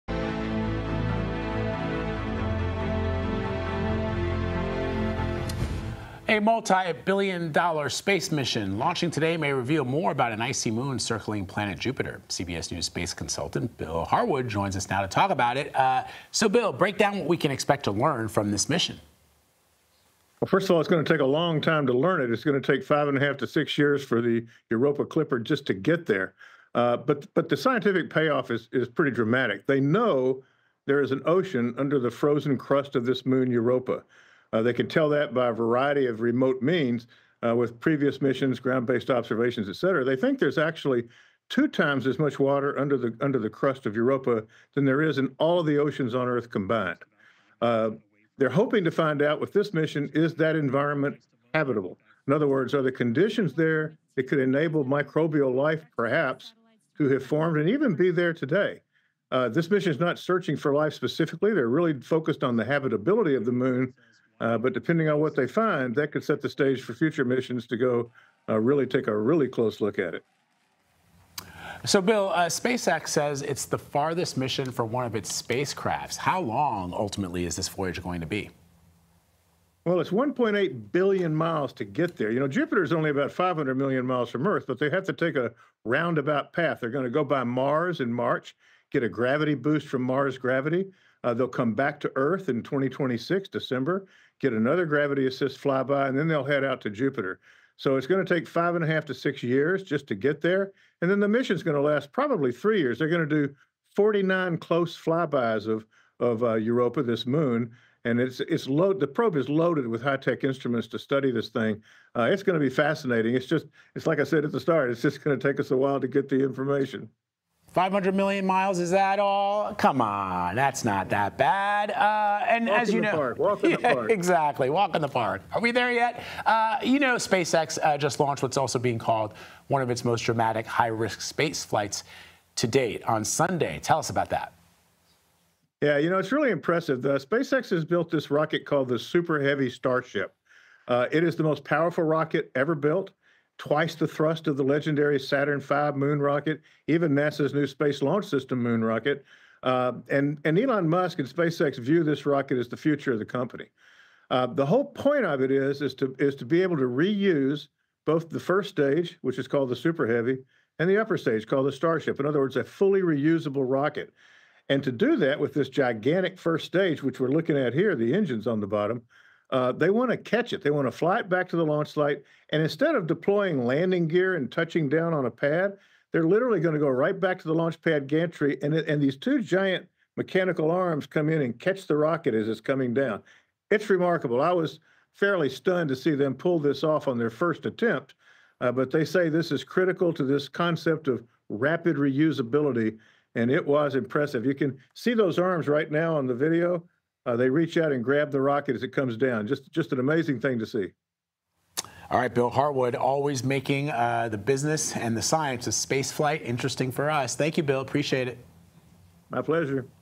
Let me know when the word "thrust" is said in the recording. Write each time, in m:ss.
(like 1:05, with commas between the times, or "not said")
2:24.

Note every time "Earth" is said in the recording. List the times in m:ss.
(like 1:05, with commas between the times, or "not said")
0:46, 1:24, 1:32.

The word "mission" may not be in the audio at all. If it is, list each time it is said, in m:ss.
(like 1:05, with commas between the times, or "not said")
0:08, 0:18, 0:38, 0:49, 0:59, 1:07, 1:14, 1:41.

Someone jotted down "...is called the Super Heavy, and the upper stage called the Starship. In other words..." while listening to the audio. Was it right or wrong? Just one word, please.
right.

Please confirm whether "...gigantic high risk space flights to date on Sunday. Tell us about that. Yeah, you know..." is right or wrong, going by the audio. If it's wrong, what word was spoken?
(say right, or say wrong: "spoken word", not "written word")
wrong: "dramatic", not "gigantic".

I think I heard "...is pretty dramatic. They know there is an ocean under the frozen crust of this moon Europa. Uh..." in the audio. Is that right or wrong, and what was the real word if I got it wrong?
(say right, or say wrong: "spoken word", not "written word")
right.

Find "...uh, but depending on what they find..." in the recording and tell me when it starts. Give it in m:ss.
1:04.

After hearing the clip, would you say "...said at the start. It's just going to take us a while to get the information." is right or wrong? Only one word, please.
right.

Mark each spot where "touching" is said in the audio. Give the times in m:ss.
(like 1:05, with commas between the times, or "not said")
2:54.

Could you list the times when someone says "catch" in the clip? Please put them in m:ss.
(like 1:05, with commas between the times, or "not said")
2:50, 3:01.